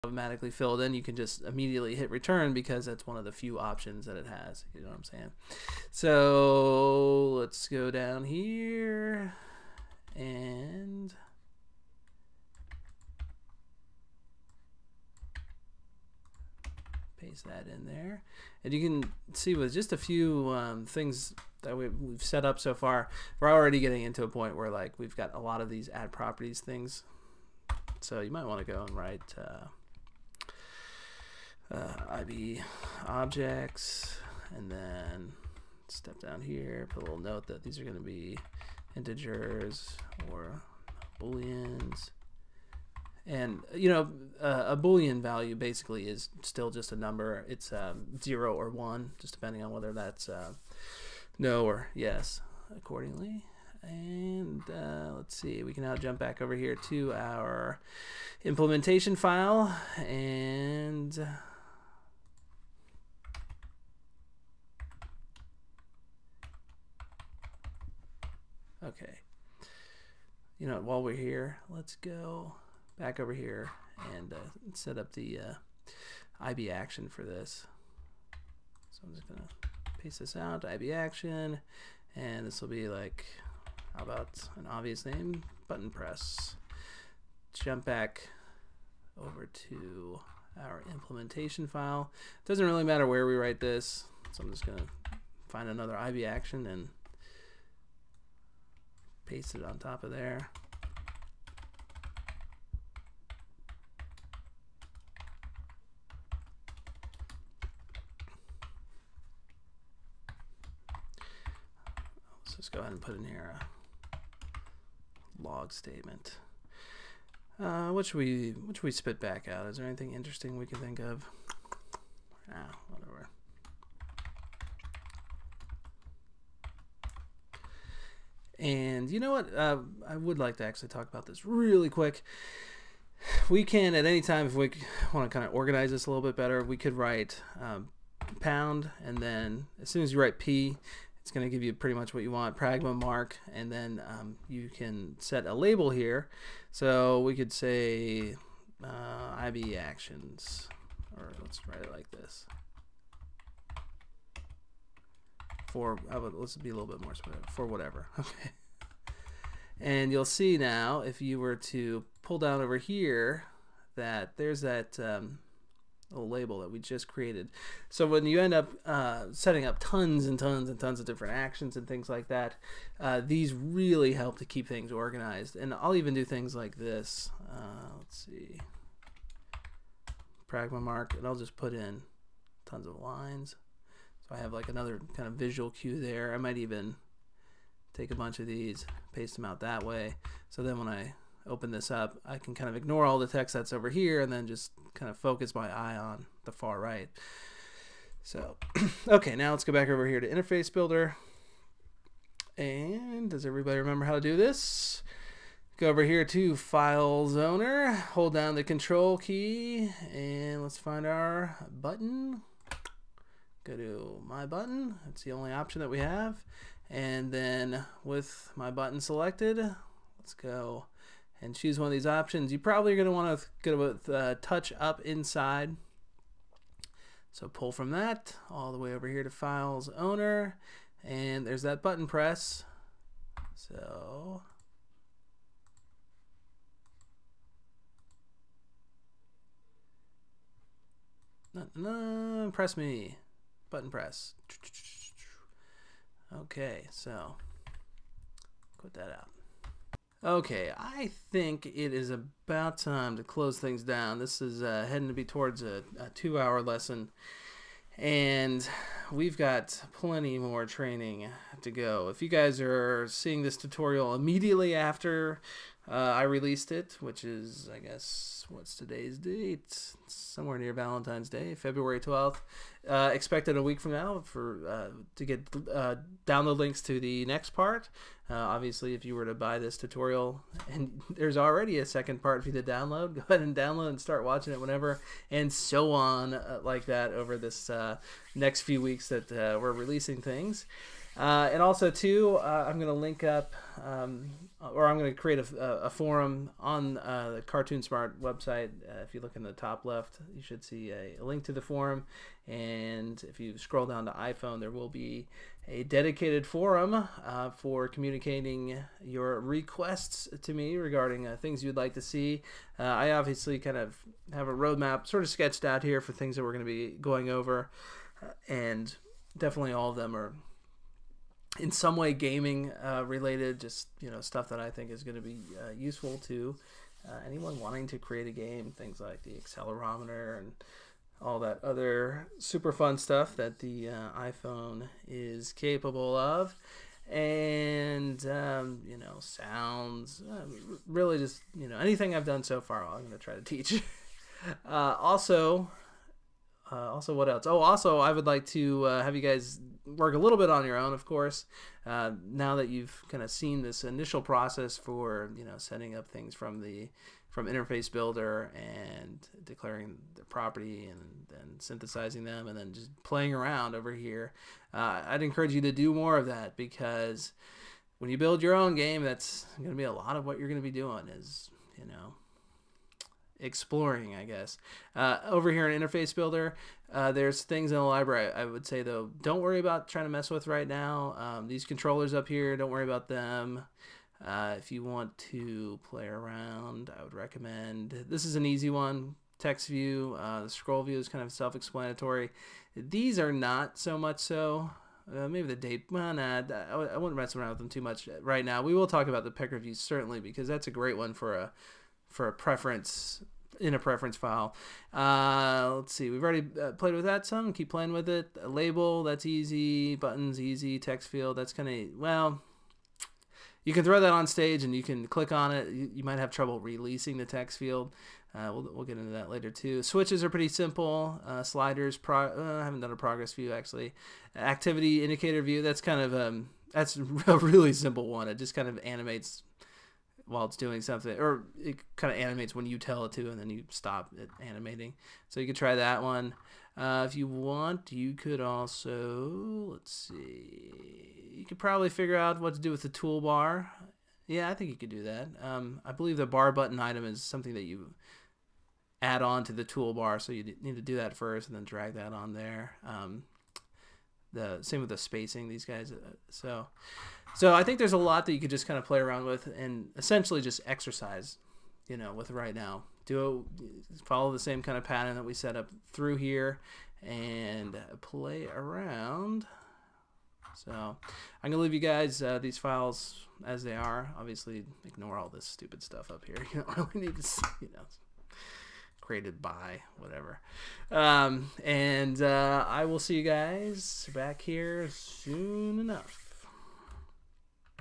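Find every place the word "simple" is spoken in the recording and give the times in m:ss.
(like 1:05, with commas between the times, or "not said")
7:00, 7:07.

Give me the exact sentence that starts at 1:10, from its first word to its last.
You know, while we're here, let's go back over here and uh, set up the uh, IB action for this.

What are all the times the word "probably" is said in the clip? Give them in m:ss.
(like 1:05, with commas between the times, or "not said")
3:42, 7:21.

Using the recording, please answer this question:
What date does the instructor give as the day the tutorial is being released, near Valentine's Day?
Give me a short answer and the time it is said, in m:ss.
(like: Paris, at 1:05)
February 12th, at 4:31.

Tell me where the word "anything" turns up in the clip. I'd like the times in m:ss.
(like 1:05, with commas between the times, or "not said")
1:59, 5:41.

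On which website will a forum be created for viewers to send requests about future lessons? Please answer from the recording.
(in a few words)
CartoonSmart.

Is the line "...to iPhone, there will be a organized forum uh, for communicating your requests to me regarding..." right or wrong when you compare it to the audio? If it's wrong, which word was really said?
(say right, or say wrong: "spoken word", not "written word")
wrong: "dedicated", not "organized".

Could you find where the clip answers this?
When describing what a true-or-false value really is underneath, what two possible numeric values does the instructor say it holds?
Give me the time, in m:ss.
0:48.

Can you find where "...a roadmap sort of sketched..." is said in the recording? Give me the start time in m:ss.
5:14.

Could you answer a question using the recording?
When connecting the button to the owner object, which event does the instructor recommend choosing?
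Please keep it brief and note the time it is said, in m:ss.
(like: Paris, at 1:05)
touch up inside, at 3:44.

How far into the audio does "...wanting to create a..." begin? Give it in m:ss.
5:27.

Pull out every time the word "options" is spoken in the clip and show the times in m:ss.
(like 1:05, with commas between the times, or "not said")
0:03, 3:35, 3:42.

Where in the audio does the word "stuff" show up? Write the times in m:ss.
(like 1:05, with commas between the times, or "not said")
5:24, 5:32, 7:55.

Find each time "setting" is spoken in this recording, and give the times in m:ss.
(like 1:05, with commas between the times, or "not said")
2:49, 5:55.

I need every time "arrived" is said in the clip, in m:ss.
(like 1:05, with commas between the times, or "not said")
not said.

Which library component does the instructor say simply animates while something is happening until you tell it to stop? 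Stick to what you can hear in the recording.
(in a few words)
Activity indicator view.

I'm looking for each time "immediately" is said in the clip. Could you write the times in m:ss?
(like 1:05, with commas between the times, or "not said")
0:01, 4:24.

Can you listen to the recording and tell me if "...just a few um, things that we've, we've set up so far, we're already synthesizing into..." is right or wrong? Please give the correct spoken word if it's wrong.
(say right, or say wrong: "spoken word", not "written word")
wrong: "getting", not "synthesizing".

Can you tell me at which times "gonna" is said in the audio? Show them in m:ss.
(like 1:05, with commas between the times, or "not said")
1:19, 1:34, 7:51.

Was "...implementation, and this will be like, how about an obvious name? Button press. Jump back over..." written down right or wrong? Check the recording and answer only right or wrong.
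wrong.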